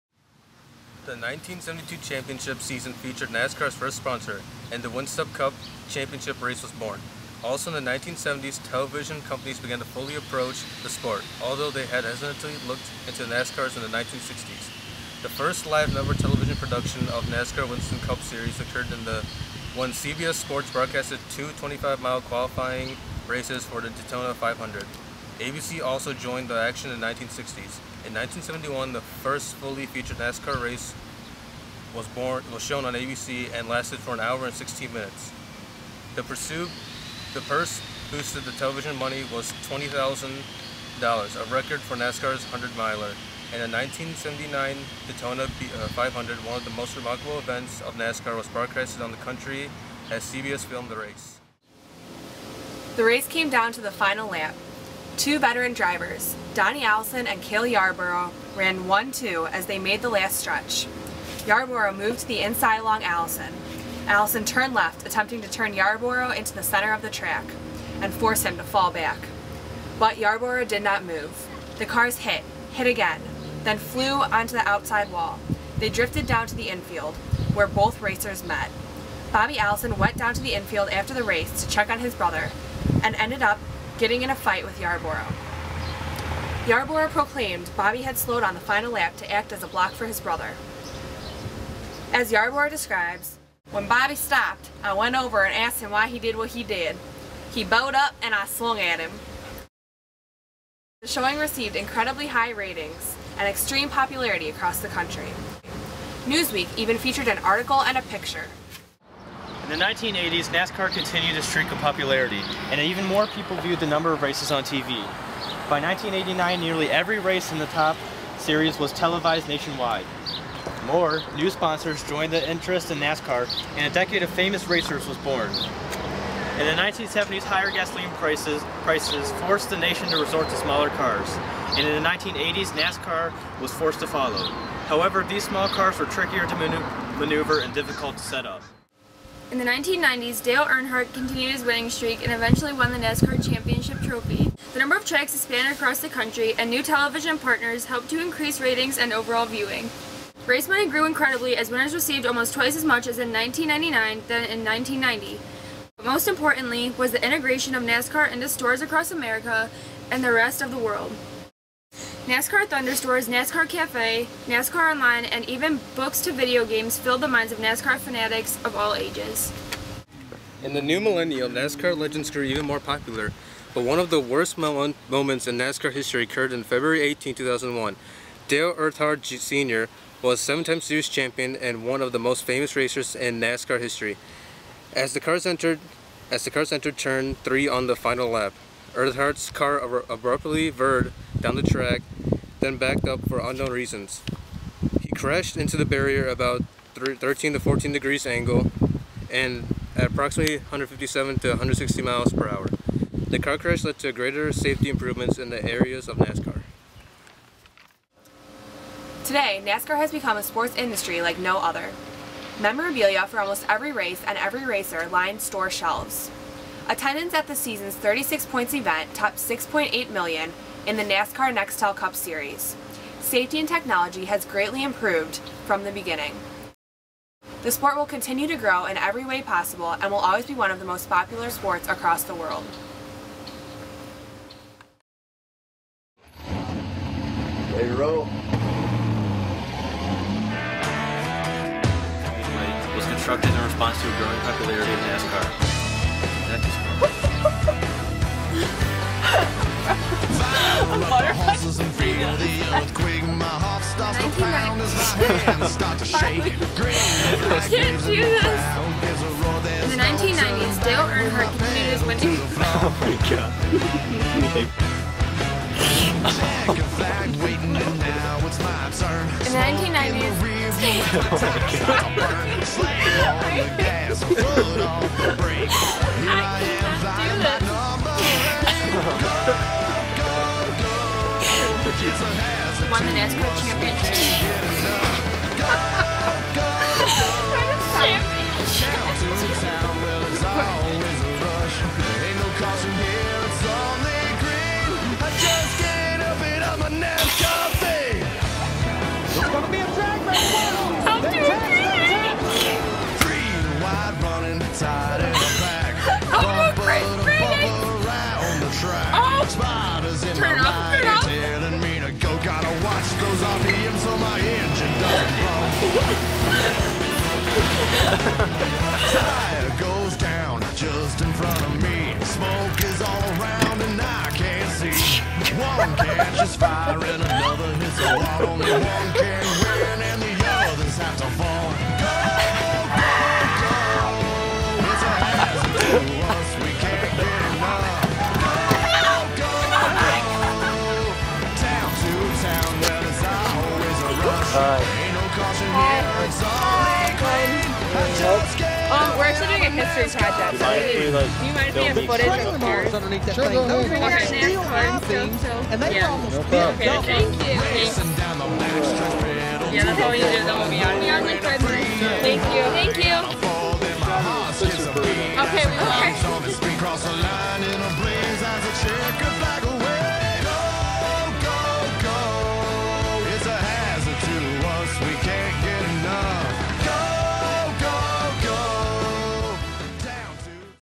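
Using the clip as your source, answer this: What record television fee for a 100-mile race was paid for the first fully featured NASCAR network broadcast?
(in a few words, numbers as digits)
$20,000.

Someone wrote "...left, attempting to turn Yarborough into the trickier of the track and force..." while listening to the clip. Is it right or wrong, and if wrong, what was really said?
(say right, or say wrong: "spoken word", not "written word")
wrong: "center", not "trickier".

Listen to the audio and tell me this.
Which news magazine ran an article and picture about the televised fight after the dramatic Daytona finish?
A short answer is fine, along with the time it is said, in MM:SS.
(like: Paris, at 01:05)
Newsweek, at 01:46.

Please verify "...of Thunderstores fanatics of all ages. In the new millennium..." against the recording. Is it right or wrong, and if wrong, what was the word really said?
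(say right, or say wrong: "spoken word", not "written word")
wrong: "NASCAR", not "Thunderstores".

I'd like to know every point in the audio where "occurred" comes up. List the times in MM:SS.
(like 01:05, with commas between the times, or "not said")
00:18, 02:56.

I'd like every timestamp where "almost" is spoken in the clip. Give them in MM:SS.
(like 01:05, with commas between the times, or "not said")
02:32, 03:33.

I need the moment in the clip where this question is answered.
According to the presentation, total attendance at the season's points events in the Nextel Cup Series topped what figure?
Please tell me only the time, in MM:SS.
03:39.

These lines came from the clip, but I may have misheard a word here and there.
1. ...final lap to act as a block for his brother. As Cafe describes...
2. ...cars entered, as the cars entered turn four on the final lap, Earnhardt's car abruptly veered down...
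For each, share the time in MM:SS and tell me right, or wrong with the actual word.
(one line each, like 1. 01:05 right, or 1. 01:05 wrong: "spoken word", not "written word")
1. 01:28 wrong: "Yarborough", not "Cafe"
2. 03:05 wrong: "three", not "four".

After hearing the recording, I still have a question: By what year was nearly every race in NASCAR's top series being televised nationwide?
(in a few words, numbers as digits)
1989.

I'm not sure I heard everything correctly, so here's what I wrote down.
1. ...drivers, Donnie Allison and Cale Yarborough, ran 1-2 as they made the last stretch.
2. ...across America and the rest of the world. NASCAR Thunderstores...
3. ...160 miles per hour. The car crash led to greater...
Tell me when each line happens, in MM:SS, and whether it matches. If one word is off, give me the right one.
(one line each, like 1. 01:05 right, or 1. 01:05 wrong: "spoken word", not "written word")
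1. 00:55 right
2. 02:38 right
3. 03:21 right.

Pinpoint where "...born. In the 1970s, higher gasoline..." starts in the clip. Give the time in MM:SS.
02:05.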